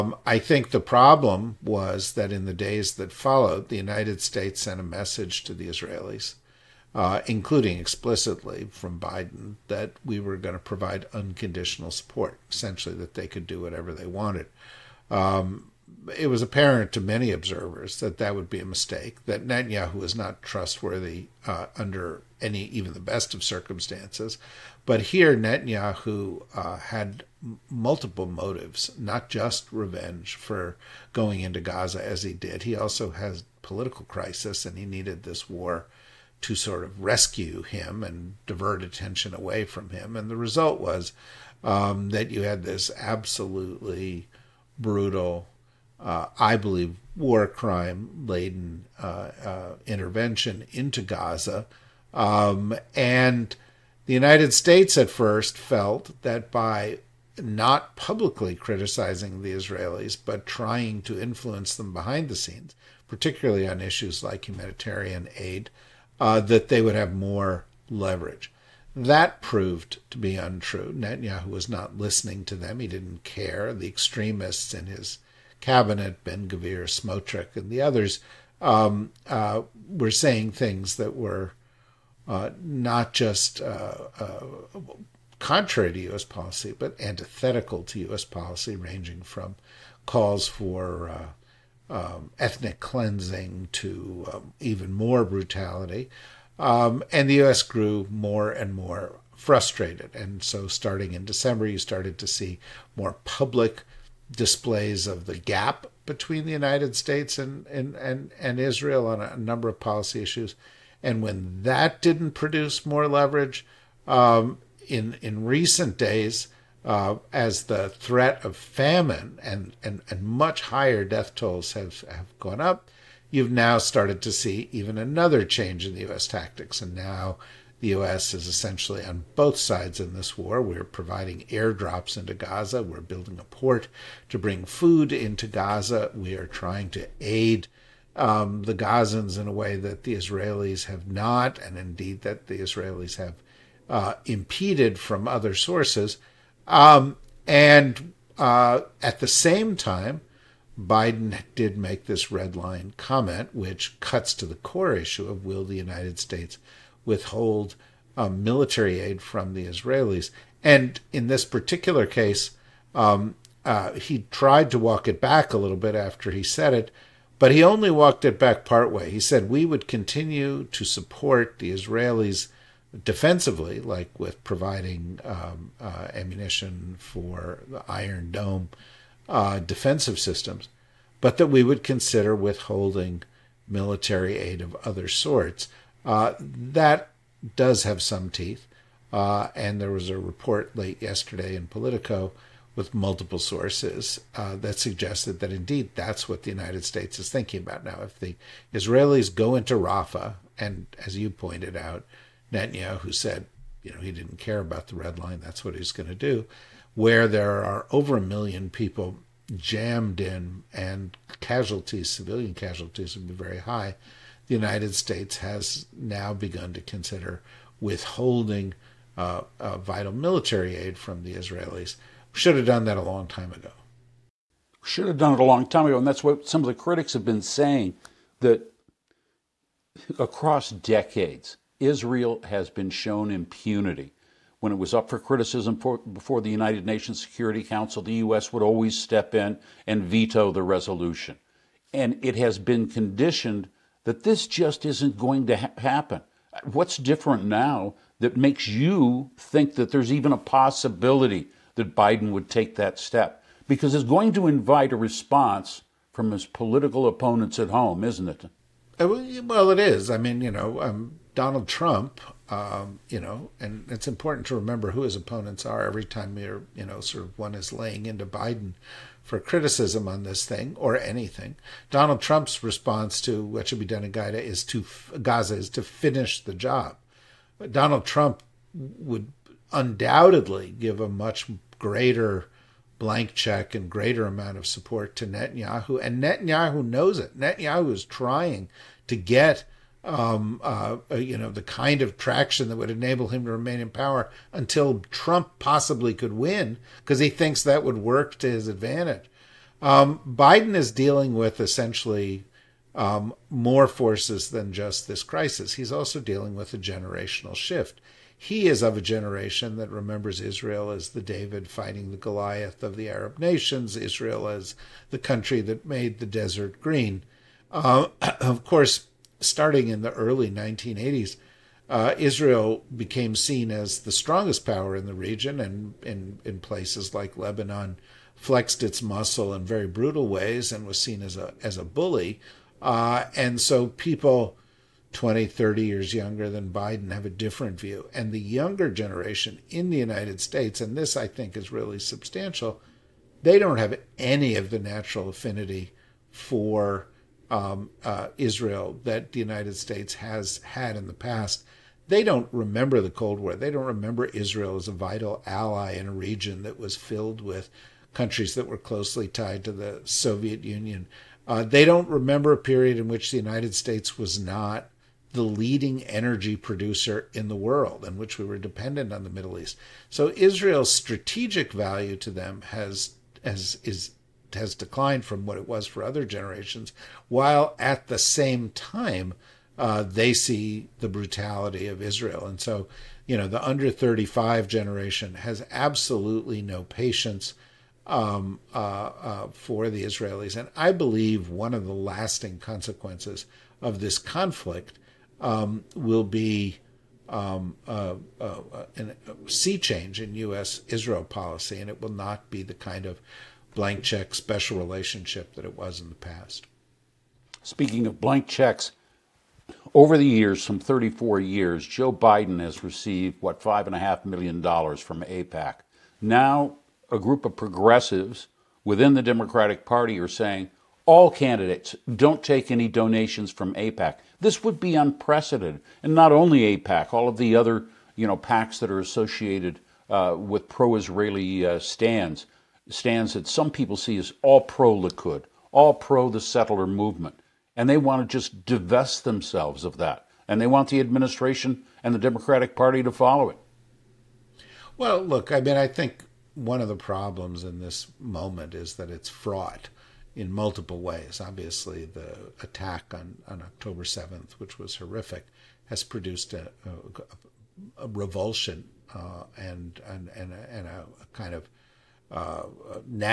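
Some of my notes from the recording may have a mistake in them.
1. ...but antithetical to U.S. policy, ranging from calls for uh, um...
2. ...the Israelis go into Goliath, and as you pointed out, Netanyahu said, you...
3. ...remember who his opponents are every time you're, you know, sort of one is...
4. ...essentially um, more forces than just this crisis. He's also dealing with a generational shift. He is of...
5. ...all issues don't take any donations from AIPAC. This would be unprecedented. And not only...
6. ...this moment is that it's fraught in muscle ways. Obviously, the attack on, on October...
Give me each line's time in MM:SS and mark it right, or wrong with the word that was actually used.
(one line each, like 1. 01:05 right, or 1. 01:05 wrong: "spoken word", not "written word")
1. 01:26 right
2. 03:18 wrong: "Rafah", not "Goliath"
3. 04:24 right
4. 05:01 right
5. 07:01 wrong: "candidates", not "issues"
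6. 07:27 wrong: "multiple", not "muscle".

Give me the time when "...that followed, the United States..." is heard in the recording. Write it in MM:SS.
00:02.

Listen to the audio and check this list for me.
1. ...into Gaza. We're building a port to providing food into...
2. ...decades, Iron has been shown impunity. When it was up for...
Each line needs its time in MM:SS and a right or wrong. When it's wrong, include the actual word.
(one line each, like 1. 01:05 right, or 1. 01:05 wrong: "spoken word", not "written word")
1. 02:12 wrong: "bring", not "providing"
2. 03:50 wrong: "Israel", not "Iron".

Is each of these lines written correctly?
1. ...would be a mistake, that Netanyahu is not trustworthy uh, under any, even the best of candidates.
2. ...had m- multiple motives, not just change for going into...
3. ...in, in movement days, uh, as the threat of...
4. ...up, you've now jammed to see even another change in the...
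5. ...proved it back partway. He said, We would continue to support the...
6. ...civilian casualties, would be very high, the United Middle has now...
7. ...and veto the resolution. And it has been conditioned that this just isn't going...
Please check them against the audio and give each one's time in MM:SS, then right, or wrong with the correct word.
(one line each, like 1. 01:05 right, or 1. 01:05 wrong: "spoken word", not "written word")
1. 00:18 wrong: "circumstances", not "candidates"
2. 00:26 wrong: "revenge", not "change"
3. 01:54 wrong: "recent", not "movement"
4. 02:02 wrong: "started", not "jammed"
5. 02:47 wrong: "walked", not "proved"
6. 03:32 wrong: "States", not "Middle"
7. 03:59 right.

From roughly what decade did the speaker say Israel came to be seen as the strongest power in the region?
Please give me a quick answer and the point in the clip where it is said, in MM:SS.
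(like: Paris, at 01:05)
early 1980s, at 05:20.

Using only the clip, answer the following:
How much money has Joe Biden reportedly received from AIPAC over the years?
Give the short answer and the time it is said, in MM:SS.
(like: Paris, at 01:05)
$5.5 million, at 06:53.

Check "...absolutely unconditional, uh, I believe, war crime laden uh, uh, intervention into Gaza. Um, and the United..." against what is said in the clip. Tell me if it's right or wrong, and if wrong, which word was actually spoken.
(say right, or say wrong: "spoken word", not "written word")
wrong: "brutal", not "unconditional".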